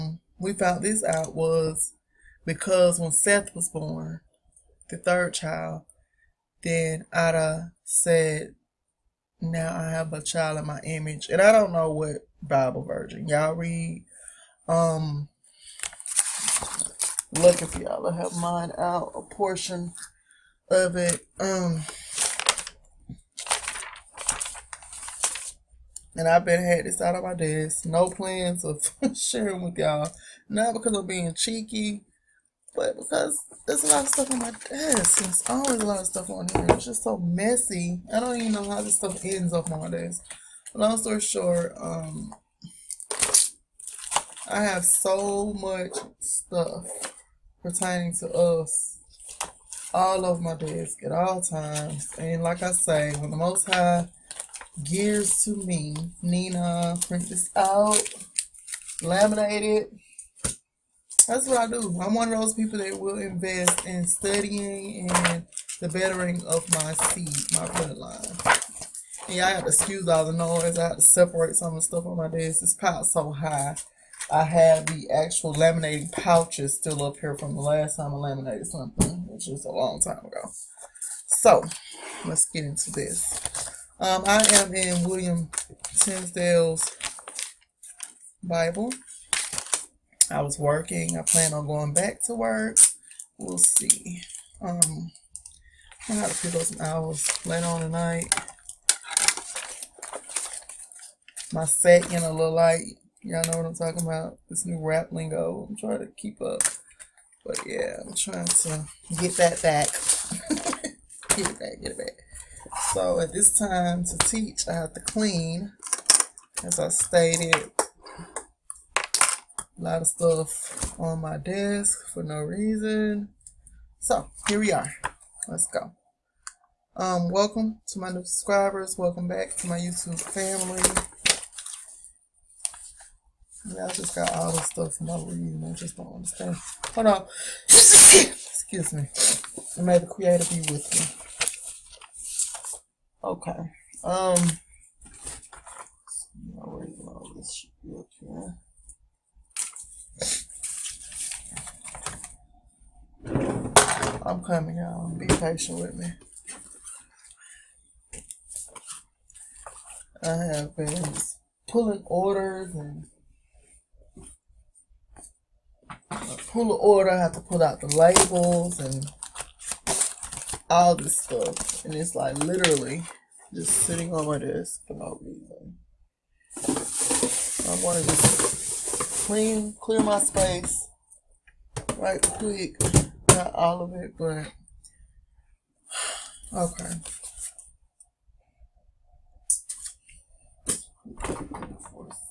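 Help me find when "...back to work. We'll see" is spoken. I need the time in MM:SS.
01:31.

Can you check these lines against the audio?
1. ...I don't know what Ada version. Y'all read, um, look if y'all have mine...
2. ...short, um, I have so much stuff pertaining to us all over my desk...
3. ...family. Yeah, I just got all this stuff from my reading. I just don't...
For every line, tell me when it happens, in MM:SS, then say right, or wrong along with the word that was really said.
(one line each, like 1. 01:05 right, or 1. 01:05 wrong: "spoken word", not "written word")
1. 00:11 wrong: "Bible", not "Ada"
2. 00:41 right
3. 02:10 right.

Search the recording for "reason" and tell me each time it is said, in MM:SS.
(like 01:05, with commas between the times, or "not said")
02:02, 02:55.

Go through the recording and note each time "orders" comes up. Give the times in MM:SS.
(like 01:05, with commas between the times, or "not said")
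02:42, 02:46.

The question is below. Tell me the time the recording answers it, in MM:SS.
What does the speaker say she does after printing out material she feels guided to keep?
00:59.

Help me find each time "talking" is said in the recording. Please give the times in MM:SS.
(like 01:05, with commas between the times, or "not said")
01:43.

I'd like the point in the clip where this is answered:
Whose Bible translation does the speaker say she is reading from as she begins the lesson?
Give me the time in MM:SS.
01:25.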